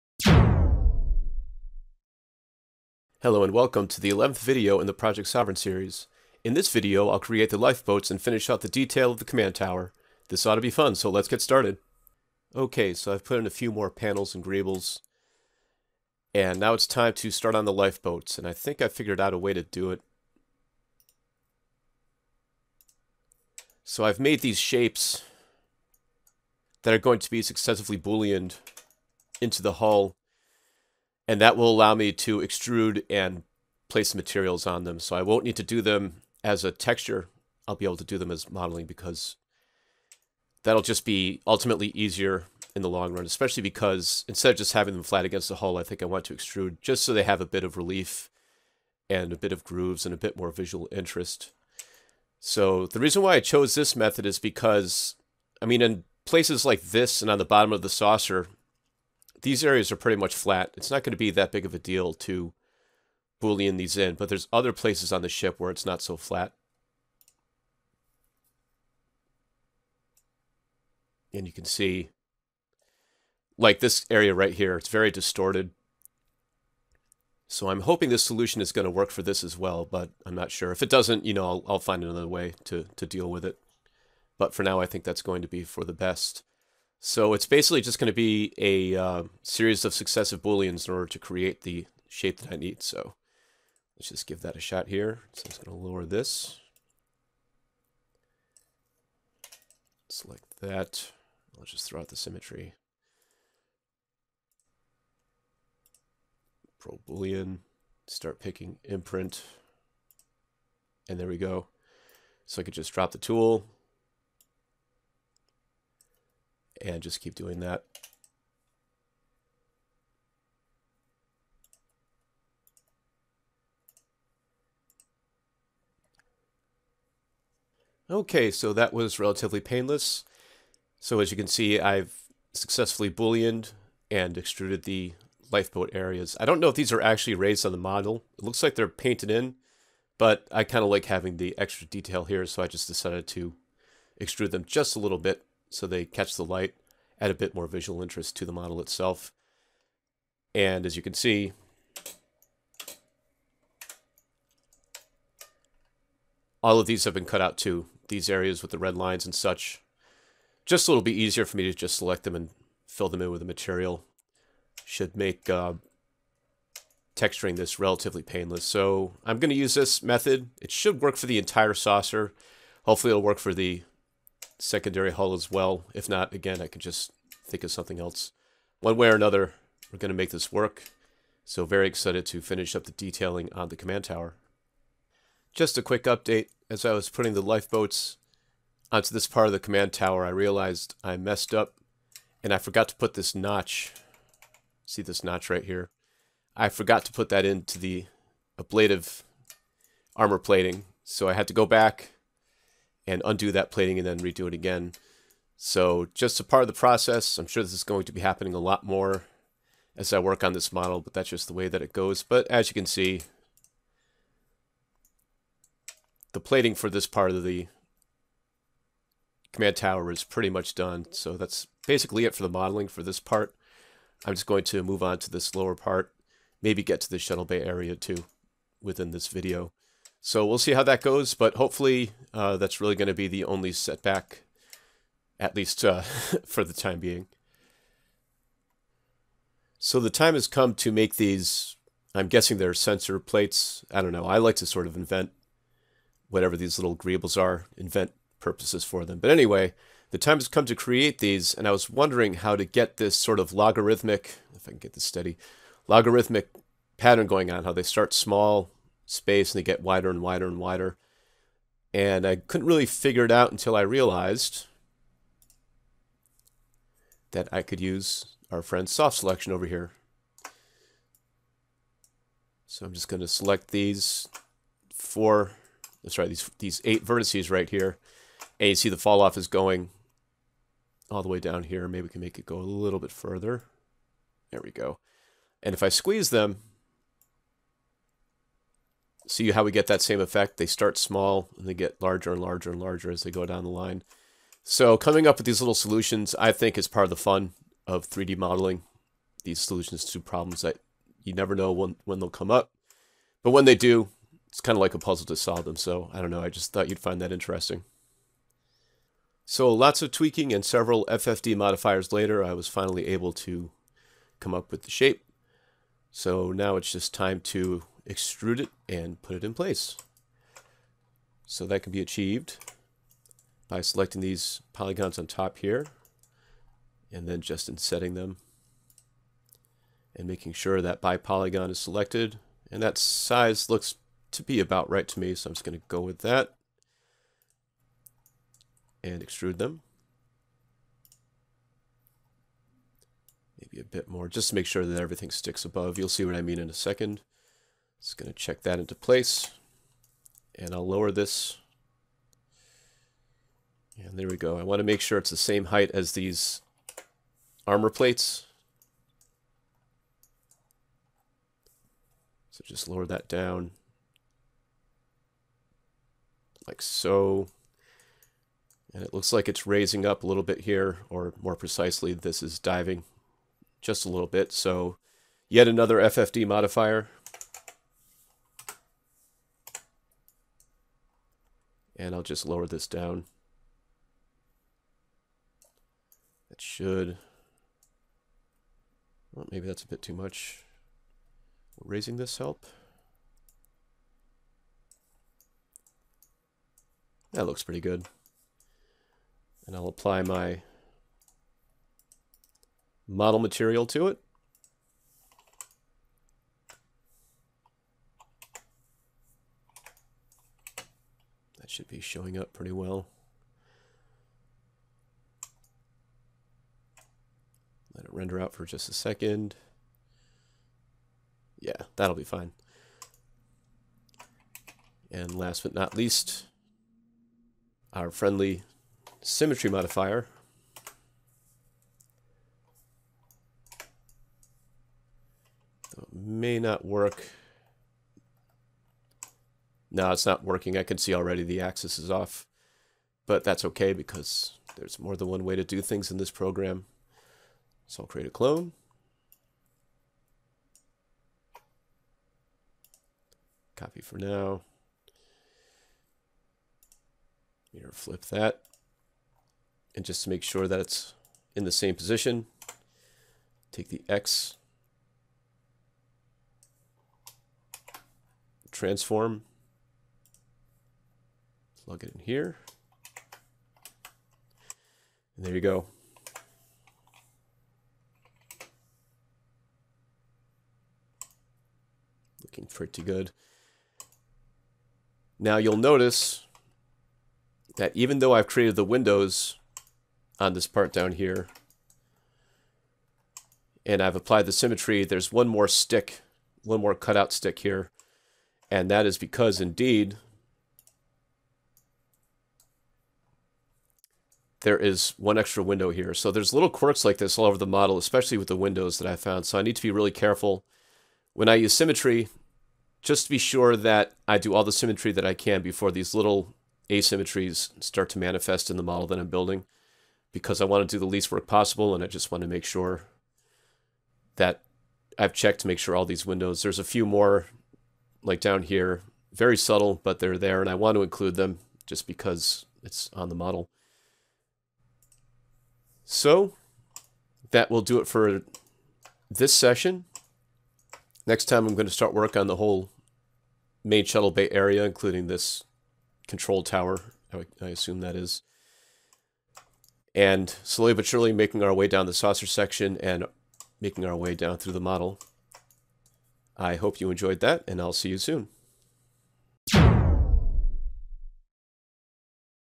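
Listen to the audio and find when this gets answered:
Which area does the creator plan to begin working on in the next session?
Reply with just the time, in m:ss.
9:03.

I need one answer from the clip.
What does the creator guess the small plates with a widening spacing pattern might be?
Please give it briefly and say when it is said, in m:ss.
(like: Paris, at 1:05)
sensor plates, at 4:02.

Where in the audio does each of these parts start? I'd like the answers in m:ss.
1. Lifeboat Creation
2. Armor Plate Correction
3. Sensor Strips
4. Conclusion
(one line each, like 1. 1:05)
1. 0:12
2. 2:07
3. 3:58
4. 8:55.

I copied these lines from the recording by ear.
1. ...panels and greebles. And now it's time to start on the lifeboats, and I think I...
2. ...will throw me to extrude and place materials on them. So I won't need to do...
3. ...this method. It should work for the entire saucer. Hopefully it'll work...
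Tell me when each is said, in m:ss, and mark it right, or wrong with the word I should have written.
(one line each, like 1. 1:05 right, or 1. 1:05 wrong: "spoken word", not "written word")
1. 0:13 right
2. 0:31 wrong: "allow", not "throw"
3. 2:49 right.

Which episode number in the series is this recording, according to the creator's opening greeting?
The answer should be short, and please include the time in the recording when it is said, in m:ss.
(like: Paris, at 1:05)
11th, at 0:04.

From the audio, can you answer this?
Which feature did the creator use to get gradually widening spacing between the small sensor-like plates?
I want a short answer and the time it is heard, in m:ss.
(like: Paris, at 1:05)
soft selection, at 4:28.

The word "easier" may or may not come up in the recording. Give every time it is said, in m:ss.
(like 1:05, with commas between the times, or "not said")
0:41, 2:41.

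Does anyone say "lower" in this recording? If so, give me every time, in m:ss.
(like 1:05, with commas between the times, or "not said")
1:35, 3:45, 5:50, 6:02, 6:22.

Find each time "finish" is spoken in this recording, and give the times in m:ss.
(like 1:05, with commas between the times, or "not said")
0:08, 3:02.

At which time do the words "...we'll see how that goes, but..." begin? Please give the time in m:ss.
3:50.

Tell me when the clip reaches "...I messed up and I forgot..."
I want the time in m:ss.
3:11.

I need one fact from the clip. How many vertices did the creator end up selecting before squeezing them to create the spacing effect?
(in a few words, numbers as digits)
8.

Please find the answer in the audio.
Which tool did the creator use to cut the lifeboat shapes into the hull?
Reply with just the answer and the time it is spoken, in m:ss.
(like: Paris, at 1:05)
Pro Boolean, at 1:46.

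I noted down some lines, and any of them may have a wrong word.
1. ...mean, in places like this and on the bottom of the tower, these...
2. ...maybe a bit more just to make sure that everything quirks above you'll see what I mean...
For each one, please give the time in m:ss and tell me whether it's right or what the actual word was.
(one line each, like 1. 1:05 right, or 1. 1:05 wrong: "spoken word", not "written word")
1. 0:55 wrong: "saucer", not "tower"
2. 5:43 wrong: "sticks", not "quirks".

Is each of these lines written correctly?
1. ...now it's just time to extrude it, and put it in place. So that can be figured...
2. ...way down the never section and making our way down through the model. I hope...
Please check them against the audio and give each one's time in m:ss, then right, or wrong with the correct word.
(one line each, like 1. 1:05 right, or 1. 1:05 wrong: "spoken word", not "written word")
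1. 5:16 wrong: "achieved", not "figured"
2. 9:11 wrong: "saucer", not "never".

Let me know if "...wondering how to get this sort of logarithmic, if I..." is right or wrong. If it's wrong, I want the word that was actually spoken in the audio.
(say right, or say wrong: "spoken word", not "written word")
right.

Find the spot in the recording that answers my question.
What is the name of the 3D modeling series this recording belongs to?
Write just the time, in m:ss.
0:04.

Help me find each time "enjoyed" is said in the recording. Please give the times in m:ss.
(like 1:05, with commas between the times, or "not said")
9:17.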